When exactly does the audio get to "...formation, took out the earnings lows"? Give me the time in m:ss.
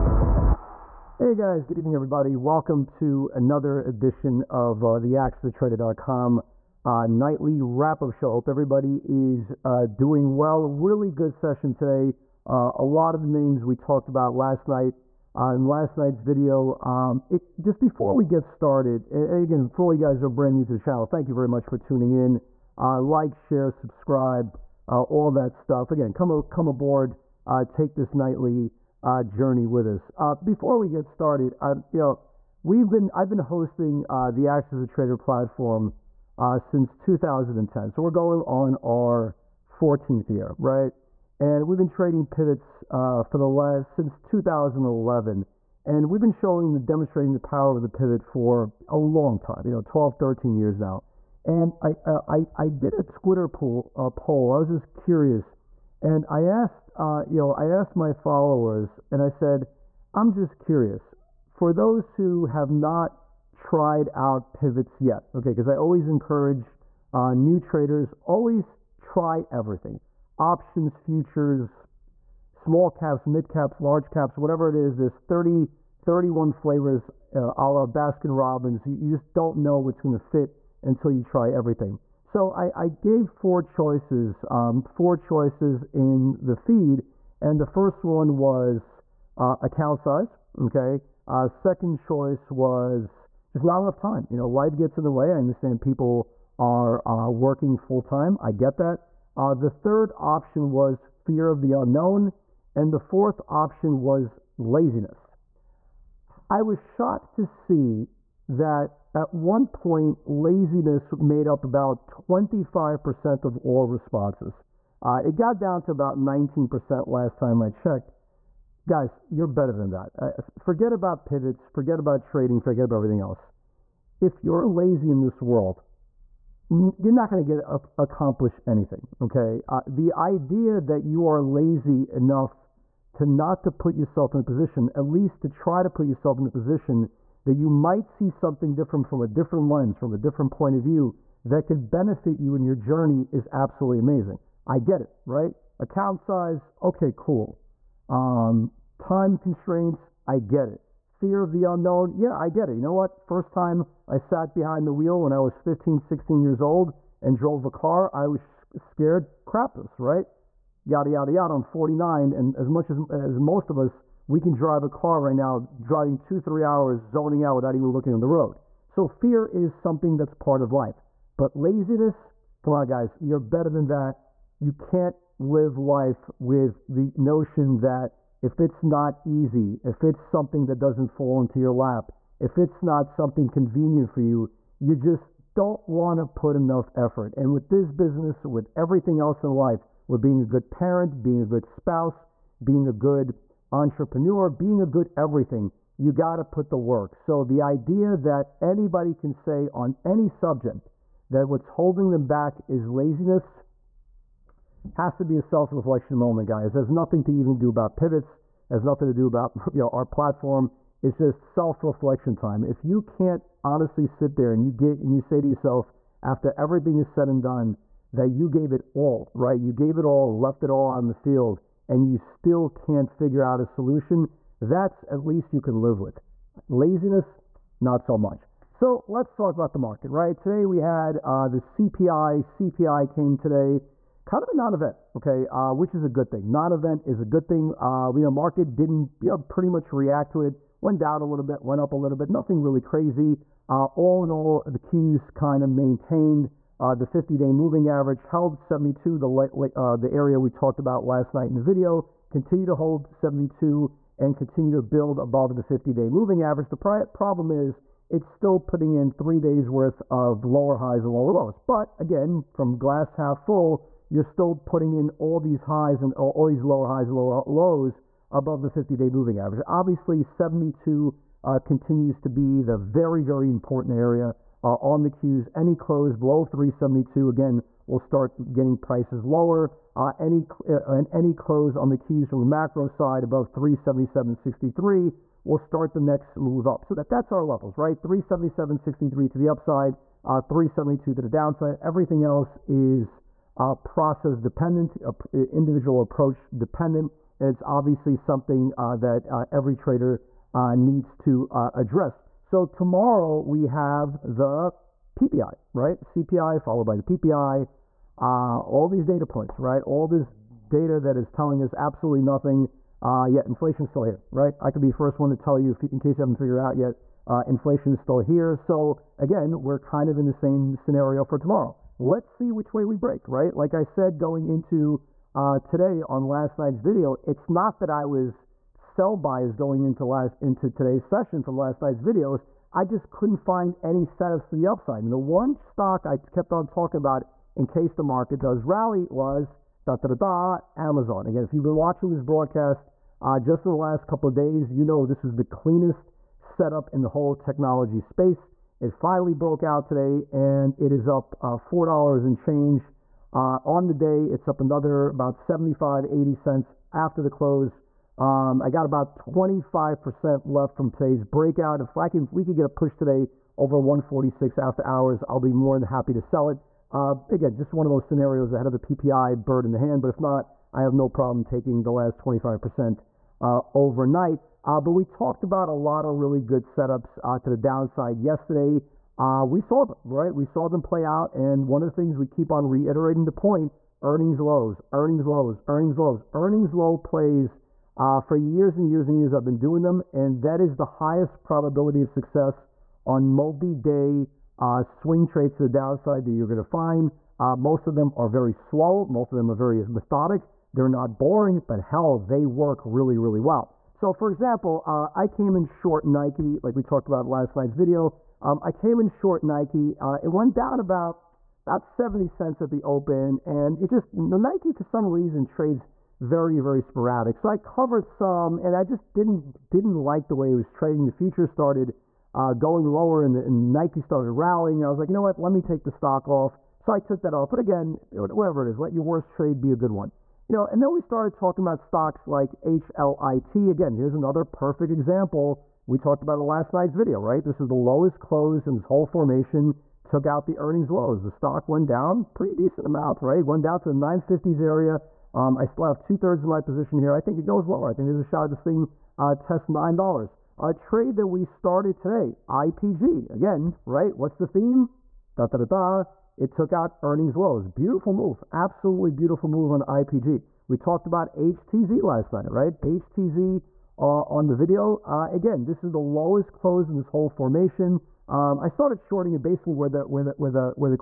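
7:19.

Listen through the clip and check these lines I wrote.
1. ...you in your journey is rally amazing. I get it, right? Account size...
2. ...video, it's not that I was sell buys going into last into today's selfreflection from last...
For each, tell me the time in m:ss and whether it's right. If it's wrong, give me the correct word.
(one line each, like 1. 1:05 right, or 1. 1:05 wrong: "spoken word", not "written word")
1. 2:22 wrong: "absolutely", not "rally"
2. 5:26 wrong: "session", not "selfreflection".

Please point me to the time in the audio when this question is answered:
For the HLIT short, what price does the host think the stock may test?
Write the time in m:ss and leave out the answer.
7:29.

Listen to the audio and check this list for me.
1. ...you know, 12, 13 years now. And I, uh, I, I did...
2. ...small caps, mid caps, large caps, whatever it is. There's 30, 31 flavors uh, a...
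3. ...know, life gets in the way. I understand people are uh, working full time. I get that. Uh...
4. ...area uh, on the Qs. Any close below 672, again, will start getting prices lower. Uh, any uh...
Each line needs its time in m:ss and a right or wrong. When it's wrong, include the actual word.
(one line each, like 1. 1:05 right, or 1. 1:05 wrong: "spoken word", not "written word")
1. 0:49 right
2. 1:12 right
3. 1:34 right
4. 4:33 wrong: "372", not "672".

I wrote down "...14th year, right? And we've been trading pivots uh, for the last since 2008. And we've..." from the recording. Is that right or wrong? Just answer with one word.
wrong.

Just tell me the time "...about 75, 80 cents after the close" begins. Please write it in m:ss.
5:55.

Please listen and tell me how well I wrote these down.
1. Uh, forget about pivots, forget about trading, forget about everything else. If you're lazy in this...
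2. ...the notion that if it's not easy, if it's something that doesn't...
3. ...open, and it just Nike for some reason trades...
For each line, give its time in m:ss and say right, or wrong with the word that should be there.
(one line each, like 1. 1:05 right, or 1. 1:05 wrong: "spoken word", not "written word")
1. 2:00 right
2. 2:56 right
3. 6:52 right.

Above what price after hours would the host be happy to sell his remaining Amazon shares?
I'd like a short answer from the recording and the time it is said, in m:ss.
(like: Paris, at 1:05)
146, at 6:03.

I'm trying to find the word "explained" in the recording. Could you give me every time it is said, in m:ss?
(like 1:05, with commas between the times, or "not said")
not said.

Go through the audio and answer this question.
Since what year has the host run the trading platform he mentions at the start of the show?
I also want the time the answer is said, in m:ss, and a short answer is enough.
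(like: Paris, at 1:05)
2010, at 0:36.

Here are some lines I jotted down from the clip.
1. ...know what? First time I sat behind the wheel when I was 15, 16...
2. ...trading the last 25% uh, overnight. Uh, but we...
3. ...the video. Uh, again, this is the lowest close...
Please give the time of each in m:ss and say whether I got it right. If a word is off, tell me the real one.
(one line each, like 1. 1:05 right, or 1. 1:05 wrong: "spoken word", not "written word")
1. 2:32 right
2. 6:11 wrong: "taking", not "trading"
3. 7:44 right.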